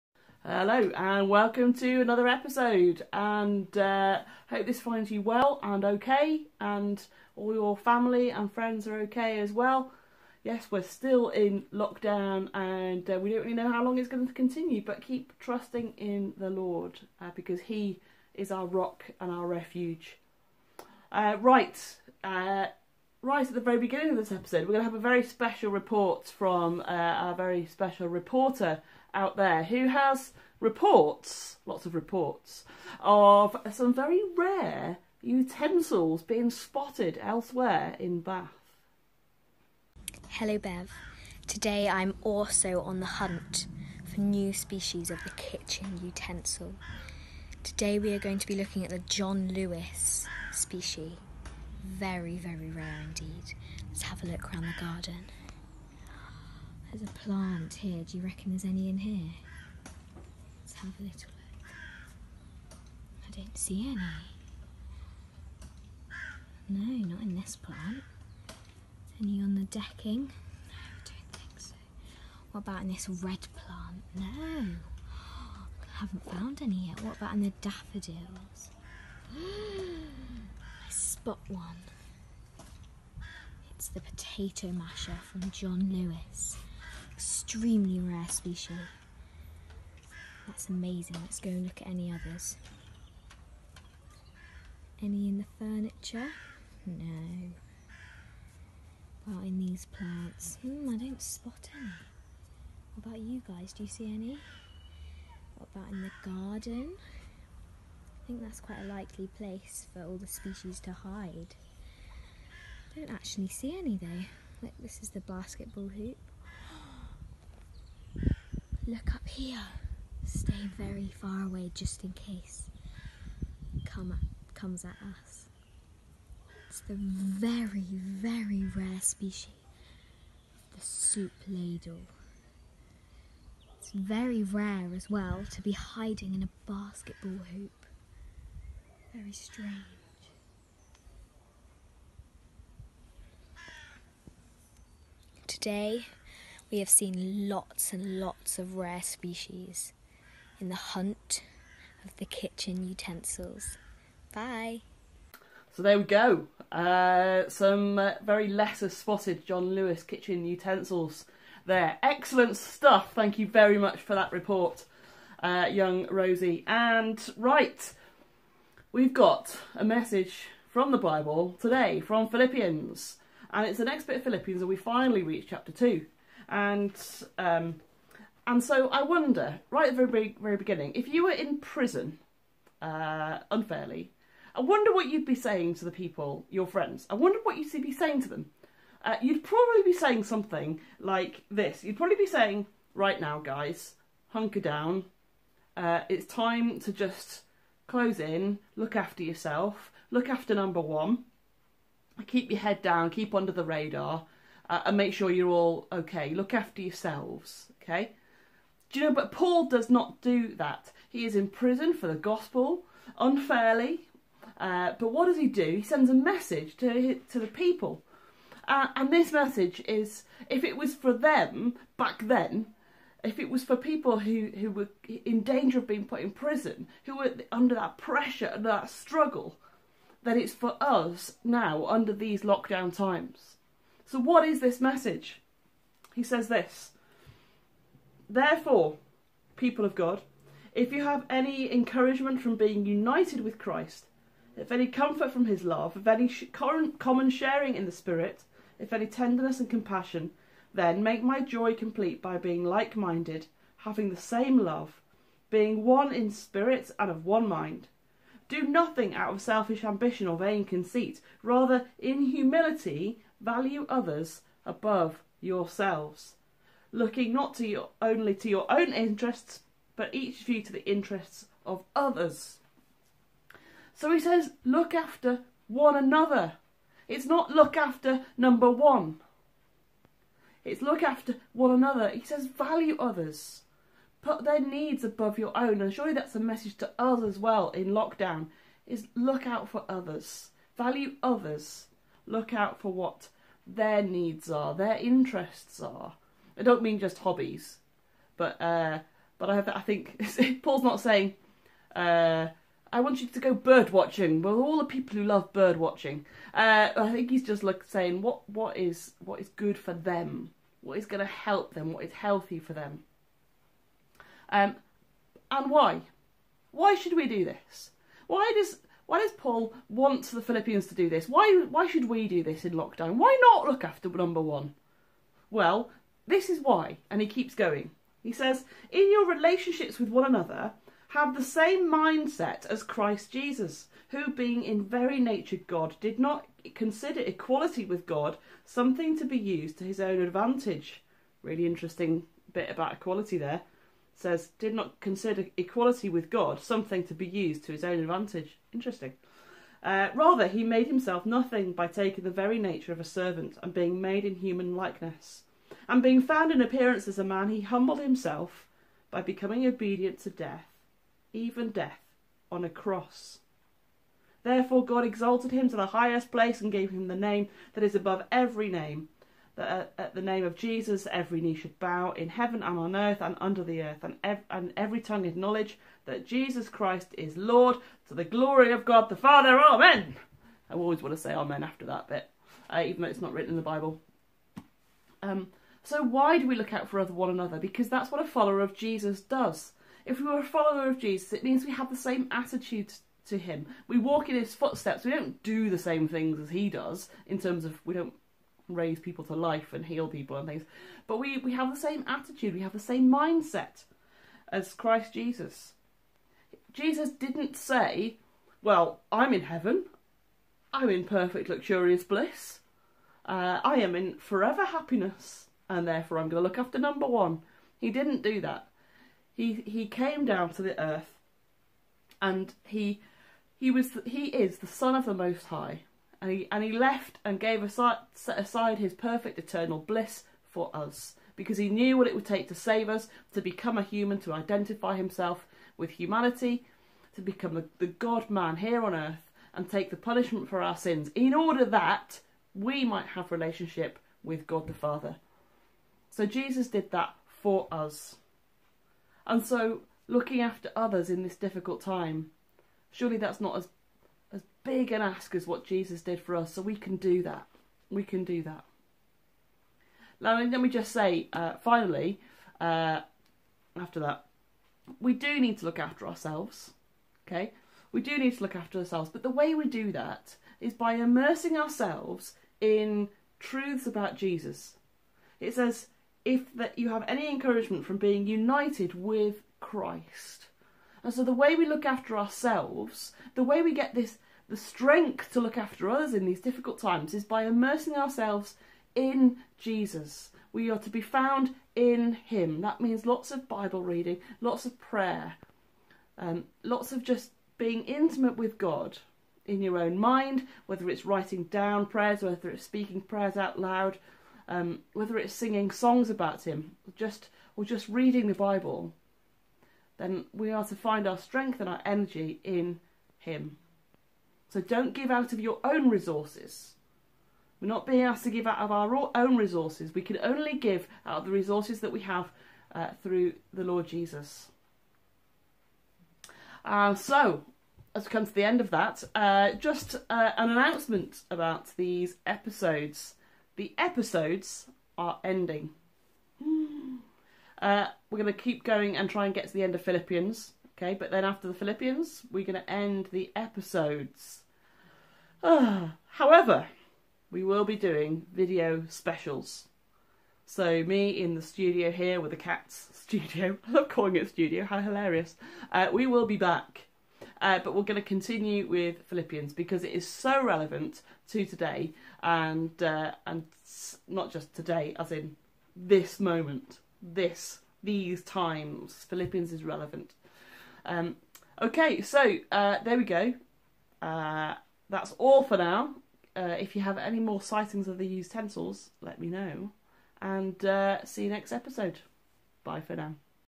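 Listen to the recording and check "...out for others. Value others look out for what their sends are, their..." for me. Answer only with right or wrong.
wrong.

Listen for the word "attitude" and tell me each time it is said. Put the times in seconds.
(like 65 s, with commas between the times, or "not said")
392 s, 402 s.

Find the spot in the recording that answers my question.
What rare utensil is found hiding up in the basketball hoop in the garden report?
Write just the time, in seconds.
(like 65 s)
130 s.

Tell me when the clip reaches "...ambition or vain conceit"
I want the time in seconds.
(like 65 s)
259 s.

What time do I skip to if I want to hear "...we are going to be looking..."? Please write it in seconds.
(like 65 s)
47 s.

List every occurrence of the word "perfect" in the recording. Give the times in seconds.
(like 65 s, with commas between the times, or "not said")
411 s, 428 s.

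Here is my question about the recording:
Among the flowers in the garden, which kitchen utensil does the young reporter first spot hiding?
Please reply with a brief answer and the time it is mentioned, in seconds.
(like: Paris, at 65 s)
Potato masher, at 84 s.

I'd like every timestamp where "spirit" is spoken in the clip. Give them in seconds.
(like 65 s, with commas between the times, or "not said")
247 s, 256 s.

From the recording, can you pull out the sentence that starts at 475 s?
It says, if that you have any encouragement from being united with Christ.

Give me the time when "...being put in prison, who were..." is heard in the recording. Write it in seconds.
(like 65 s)
225 s.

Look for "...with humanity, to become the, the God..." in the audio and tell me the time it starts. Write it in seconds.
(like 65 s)
435 s.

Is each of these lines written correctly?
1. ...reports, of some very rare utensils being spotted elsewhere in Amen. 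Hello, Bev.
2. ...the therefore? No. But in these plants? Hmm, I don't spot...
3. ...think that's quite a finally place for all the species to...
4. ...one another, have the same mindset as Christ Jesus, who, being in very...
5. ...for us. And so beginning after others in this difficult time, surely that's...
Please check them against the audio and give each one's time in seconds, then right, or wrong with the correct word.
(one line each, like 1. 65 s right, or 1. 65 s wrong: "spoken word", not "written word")
1. 31 s wrong: "Bath", not "Amen"
2. 95 s wrong: "furniture", not "therefore"
3. 108 s wrong: "likely", not "finally"
4. 330 s right
5. 447 s wrong: "looking", not "beginning".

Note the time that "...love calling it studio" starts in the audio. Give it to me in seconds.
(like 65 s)
553 s.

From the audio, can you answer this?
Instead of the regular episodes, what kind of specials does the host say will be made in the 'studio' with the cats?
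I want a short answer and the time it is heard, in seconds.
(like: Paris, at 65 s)
Video specials, at 548 s.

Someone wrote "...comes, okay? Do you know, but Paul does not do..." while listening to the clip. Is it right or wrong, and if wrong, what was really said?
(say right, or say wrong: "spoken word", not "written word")
wrong: "yourselves", not "comes".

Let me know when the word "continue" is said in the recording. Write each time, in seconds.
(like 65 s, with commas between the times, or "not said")
14 s, 558 s.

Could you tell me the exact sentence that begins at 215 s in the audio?
He sends a message to, to the people.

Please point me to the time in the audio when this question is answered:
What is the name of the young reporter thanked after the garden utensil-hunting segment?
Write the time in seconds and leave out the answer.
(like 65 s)
166 s.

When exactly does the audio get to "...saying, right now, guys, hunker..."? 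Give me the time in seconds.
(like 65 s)
192 s.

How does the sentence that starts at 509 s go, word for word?
Then we are to find our strength and our energy in Him.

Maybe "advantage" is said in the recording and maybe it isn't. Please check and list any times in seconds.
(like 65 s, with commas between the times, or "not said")
340 s, 347 s.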